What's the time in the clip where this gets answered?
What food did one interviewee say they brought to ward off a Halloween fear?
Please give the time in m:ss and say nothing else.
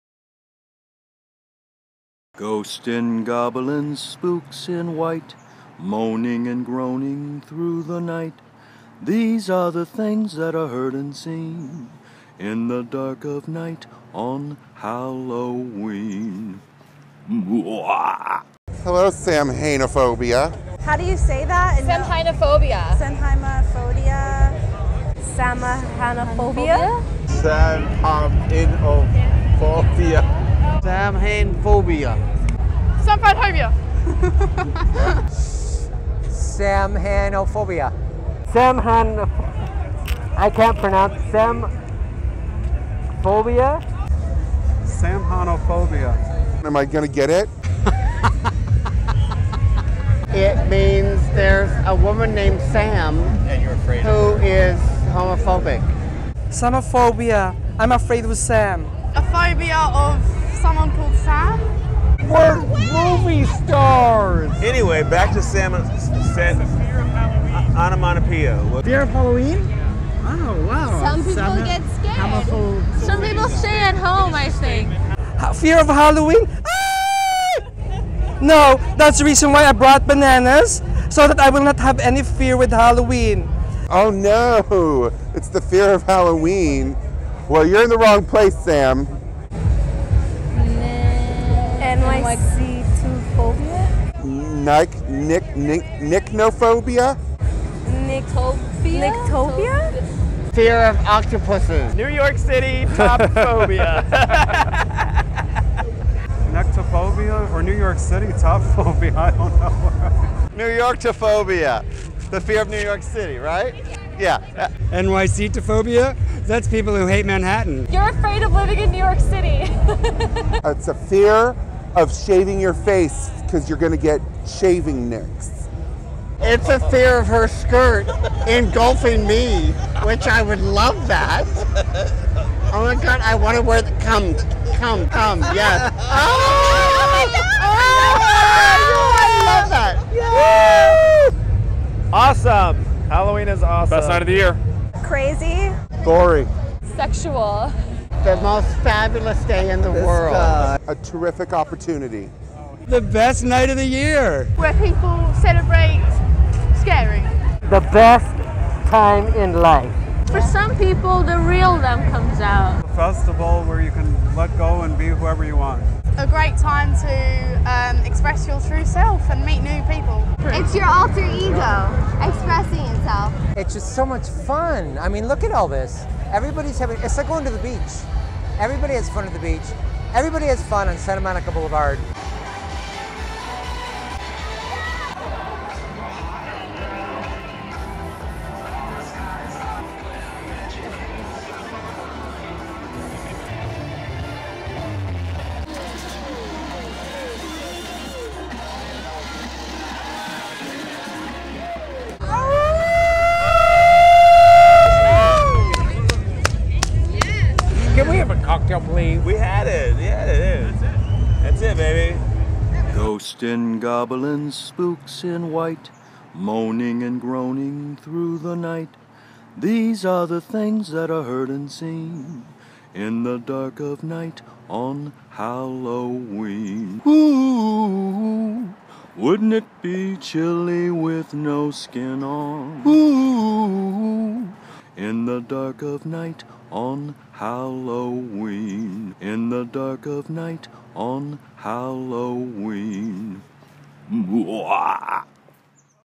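1:20.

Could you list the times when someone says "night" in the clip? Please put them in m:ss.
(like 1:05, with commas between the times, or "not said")
0:08, 0:13, 2:24, 2:33, 3:38, 3:44, 3:56, 4:00.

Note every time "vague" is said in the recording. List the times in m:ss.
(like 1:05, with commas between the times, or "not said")
not said.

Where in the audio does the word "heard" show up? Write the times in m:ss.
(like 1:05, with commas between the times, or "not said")
0:10, 3:41.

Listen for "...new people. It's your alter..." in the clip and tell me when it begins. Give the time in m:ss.
2:49.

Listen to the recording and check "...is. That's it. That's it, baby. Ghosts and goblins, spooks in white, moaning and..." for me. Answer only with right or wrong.
right.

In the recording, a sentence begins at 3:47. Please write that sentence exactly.
Ooh, wouldn't it be chilly with no skin on?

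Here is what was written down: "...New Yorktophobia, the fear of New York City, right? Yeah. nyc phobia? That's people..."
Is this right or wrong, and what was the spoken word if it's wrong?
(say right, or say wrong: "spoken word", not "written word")
right.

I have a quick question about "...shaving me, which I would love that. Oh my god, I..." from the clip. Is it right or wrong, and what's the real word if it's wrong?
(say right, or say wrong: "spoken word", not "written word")
wrong: "engulfing", not "shaving".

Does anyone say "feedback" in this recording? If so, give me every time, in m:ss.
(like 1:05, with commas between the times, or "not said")
not said.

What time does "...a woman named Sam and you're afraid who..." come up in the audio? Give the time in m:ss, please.
0:51.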